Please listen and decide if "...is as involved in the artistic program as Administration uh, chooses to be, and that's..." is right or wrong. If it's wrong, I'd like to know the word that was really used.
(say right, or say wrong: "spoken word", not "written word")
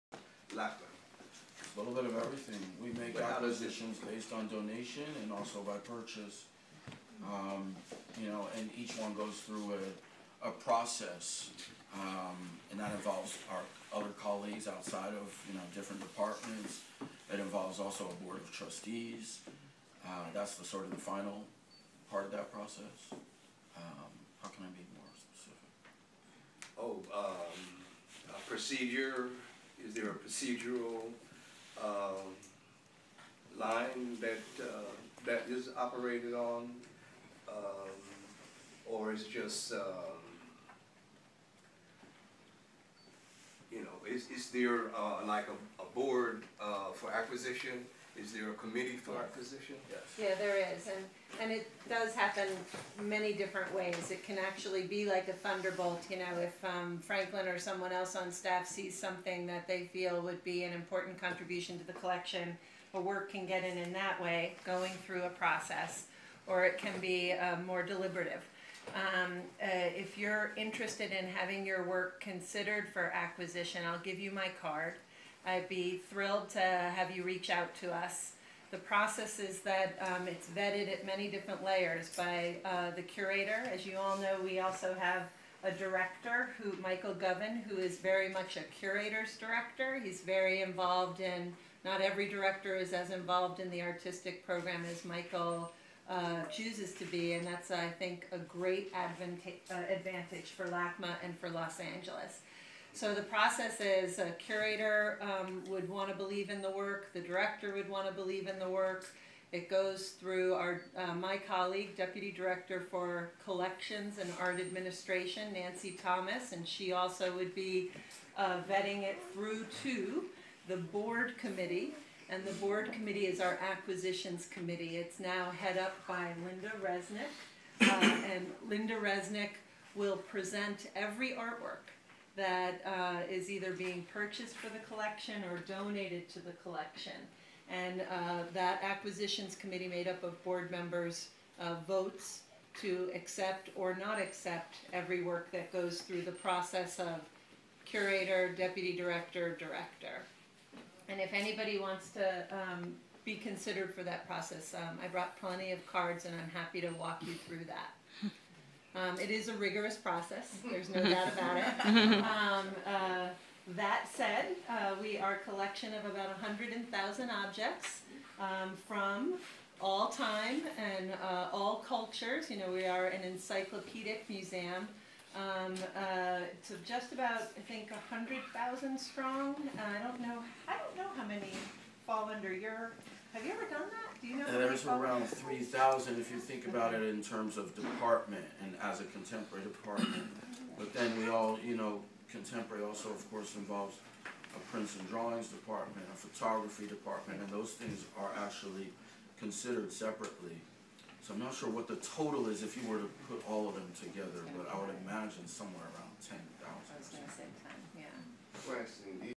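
wrong: "Michael", not "Administration".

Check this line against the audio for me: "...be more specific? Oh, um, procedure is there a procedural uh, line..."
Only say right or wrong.
right.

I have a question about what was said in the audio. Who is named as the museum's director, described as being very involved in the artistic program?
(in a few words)
Michael Govan.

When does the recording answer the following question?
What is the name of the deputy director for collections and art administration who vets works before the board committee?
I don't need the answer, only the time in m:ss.
1:55.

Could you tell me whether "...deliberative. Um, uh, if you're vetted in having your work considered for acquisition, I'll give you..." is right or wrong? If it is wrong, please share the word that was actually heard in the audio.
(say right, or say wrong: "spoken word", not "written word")
wrong: "interested", not "vetted".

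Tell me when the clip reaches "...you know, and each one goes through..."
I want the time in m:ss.
0:08.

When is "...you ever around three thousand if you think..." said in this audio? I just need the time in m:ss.
3:03.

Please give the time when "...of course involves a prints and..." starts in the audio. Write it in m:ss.
3:13.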